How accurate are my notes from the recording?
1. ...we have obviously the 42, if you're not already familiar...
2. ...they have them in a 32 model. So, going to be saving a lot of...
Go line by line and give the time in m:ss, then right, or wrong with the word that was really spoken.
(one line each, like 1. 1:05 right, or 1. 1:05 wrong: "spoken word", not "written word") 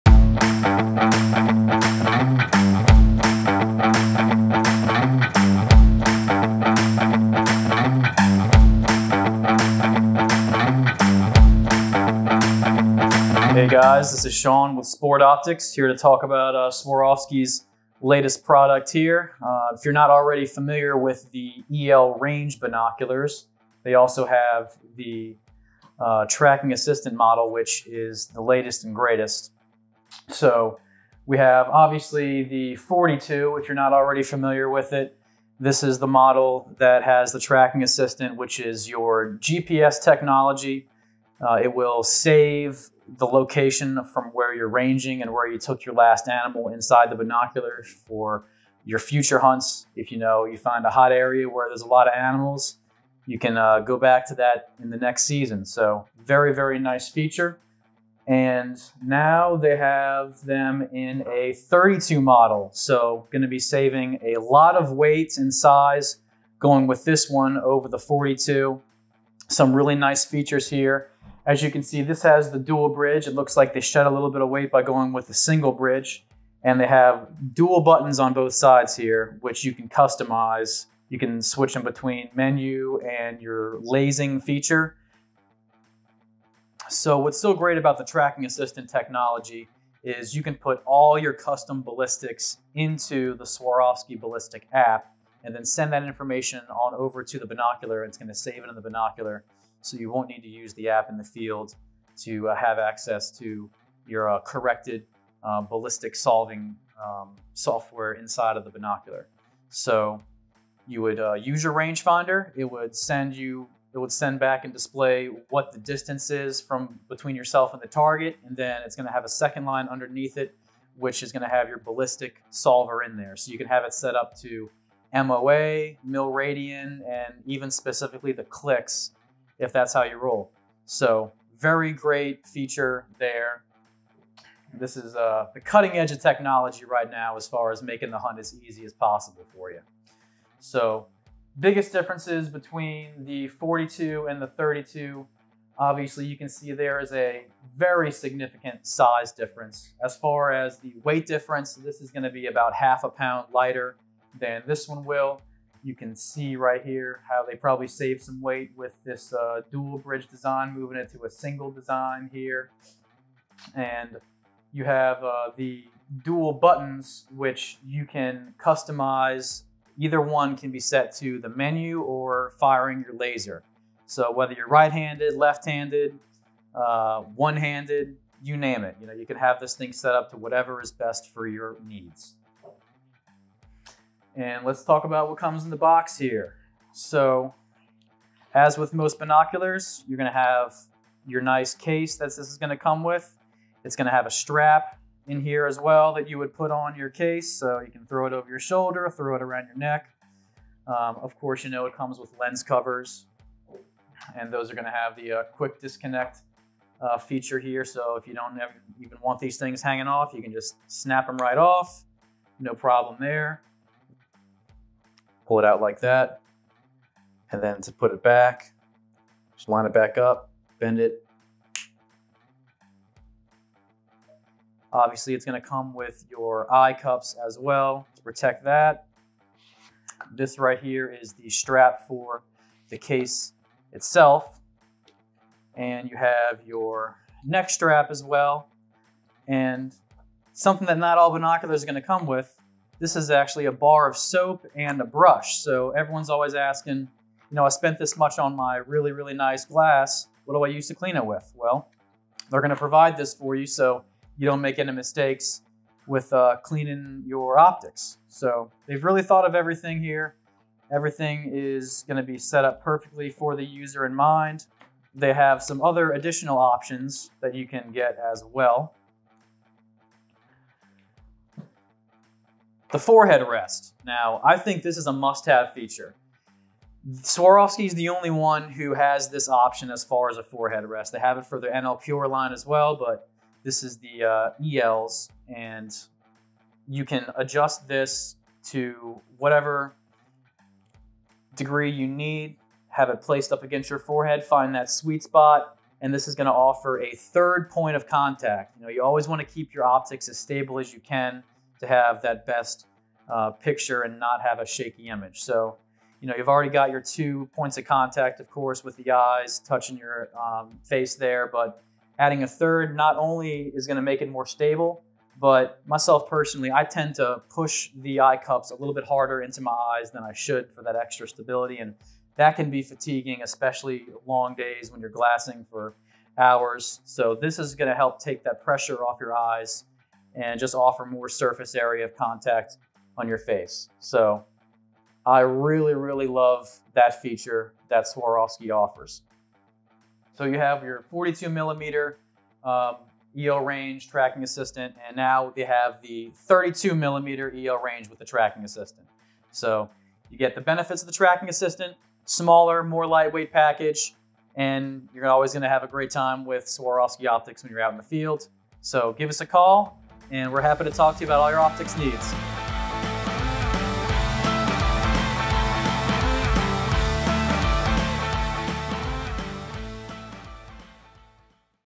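1. 0:31 right
2. 0:59 right.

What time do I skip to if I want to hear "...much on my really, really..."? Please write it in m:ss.
4:08.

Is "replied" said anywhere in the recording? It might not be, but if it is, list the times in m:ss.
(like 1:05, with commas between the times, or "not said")
not said.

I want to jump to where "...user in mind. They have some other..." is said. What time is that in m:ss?
4:23.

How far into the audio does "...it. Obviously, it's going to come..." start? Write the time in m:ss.
3:40.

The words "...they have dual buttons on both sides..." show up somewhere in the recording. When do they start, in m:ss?
1:16.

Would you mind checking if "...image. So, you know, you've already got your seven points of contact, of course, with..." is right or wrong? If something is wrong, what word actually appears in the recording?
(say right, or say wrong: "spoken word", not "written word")
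wrong: "two", not "seven".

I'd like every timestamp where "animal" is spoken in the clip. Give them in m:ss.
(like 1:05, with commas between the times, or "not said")
0:46, 0:52.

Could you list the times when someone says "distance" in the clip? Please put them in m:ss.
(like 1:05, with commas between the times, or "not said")
1:55.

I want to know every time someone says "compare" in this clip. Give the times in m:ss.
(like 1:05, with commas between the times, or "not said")
not said.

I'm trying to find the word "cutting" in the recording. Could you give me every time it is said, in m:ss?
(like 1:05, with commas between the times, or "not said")
2:15.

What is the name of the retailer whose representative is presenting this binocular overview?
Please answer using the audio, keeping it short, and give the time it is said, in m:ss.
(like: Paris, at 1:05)
Sport Optics, at 0:14.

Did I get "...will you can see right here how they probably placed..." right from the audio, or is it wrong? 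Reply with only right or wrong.
wrong.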